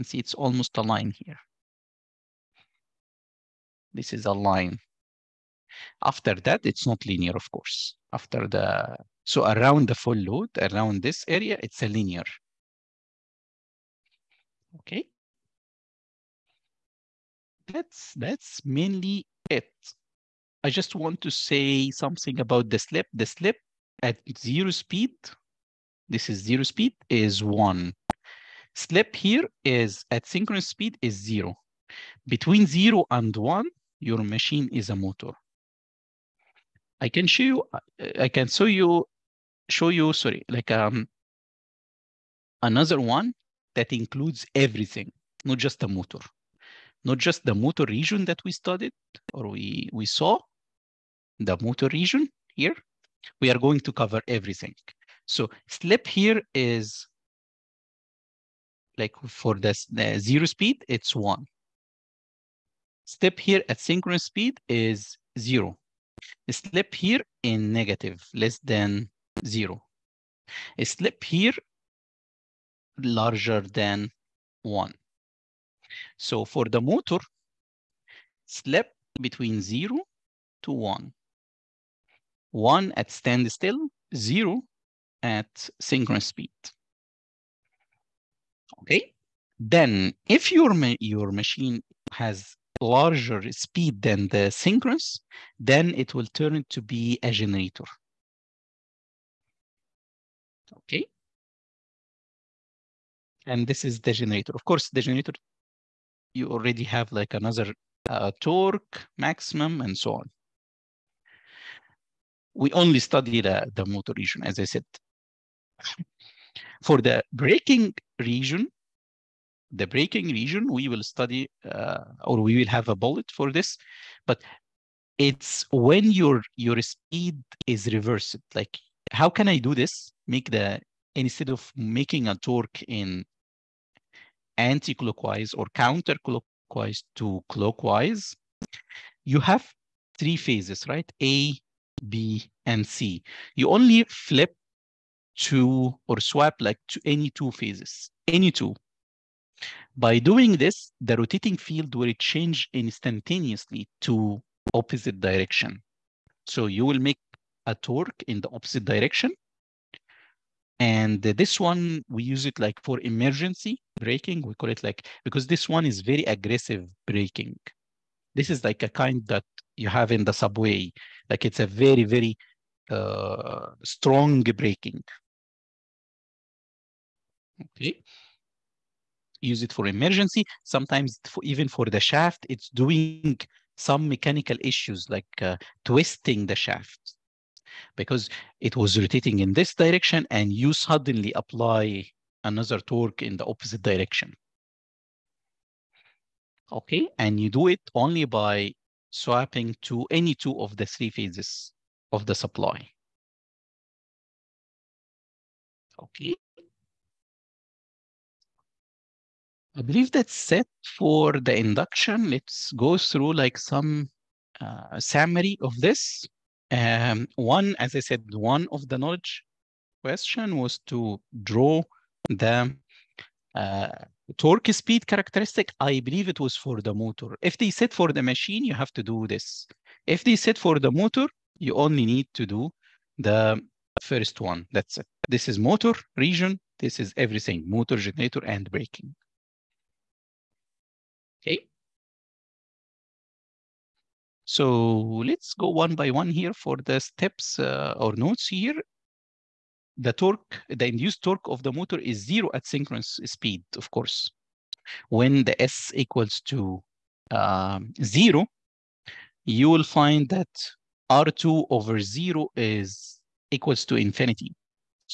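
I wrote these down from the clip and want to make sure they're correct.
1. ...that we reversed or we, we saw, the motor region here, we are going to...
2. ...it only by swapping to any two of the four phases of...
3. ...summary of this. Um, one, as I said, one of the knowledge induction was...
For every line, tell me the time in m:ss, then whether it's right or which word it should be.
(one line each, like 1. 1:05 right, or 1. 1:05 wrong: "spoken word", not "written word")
1. 0:48 wrong: "studied", not "reversed"
2. 3:17 wrong: "three", not "four"
3. 3:34 wrong: "question", not "induction".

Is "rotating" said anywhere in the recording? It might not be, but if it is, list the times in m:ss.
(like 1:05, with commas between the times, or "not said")
2:31, 3:08.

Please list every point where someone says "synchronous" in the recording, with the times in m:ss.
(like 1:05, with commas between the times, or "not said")
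0:30, 1:03, 1:25, 1:34, 4:12.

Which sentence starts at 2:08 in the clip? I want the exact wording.
Like, how can I do this?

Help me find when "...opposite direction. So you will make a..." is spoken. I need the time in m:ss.
2:34.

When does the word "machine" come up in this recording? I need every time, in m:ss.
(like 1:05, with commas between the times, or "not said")
0:34, 1:31, 3:48.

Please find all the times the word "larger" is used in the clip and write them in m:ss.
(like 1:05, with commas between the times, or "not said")
1:12, 1:32.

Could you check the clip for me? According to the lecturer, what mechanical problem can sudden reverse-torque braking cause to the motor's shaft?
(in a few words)
twisting the shaft.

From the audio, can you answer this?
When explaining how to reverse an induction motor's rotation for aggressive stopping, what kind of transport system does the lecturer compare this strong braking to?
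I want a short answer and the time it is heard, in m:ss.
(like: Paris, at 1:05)
subway, at 2:50.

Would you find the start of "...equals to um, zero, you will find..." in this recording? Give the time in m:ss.
4:15.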